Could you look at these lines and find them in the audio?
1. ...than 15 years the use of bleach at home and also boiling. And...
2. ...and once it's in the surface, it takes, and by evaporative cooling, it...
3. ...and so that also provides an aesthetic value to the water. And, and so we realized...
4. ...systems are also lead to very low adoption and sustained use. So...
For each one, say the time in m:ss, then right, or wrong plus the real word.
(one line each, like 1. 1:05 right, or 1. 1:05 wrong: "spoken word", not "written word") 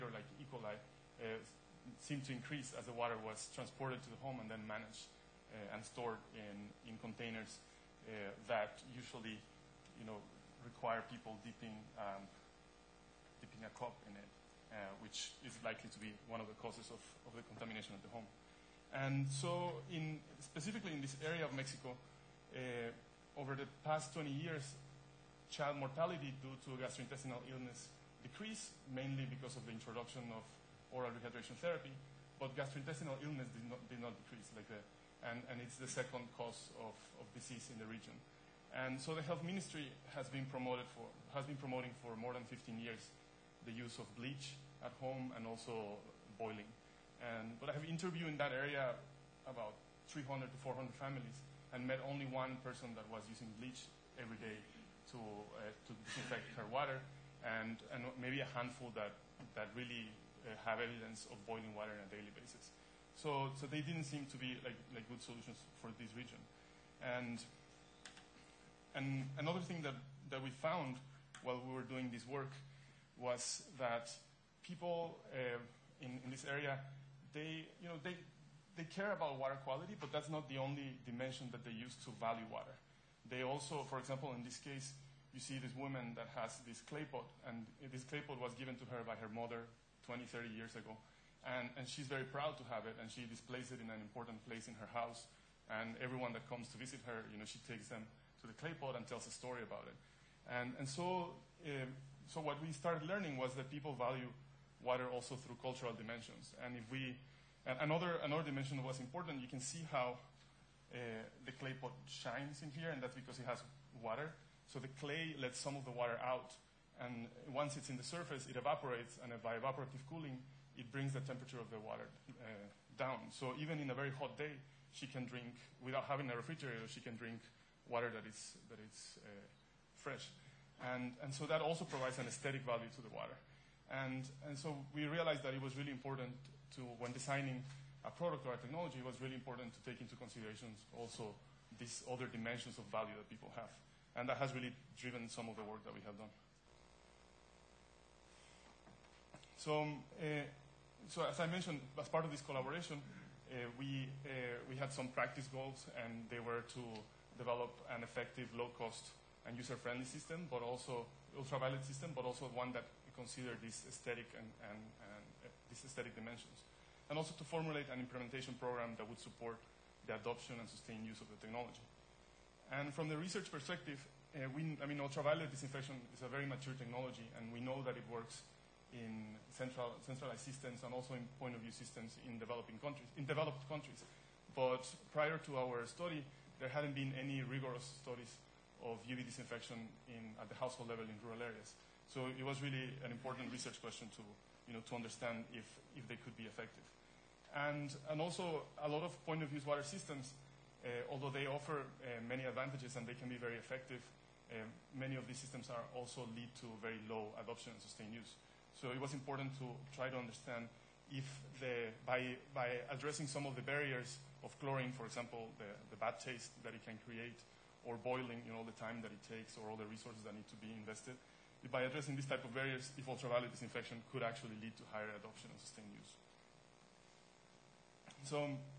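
1. 0:42 right
2. 1:57 wrong: "evaporates", not "takes"
3. 2:11 right
4. 3:25 right.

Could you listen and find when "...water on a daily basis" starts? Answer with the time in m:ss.
1:01.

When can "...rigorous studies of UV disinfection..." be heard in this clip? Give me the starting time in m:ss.
3:07.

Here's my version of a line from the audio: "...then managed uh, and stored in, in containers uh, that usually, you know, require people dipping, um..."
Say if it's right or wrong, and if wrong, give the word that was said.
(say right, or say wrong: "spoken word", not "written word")
right.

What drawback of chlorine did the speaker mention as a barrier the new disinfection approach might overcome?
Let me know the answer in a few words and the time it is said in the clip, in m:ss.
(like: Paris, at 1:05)
bad taste, at 3:35.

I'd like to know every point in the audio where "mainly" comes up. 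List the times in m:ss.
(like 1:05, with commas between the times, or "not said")
0:28.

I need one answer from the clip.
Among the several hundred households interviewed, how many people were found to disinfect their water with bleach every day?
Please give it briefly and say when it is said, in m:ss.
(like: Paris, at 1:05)
1, at 0:52.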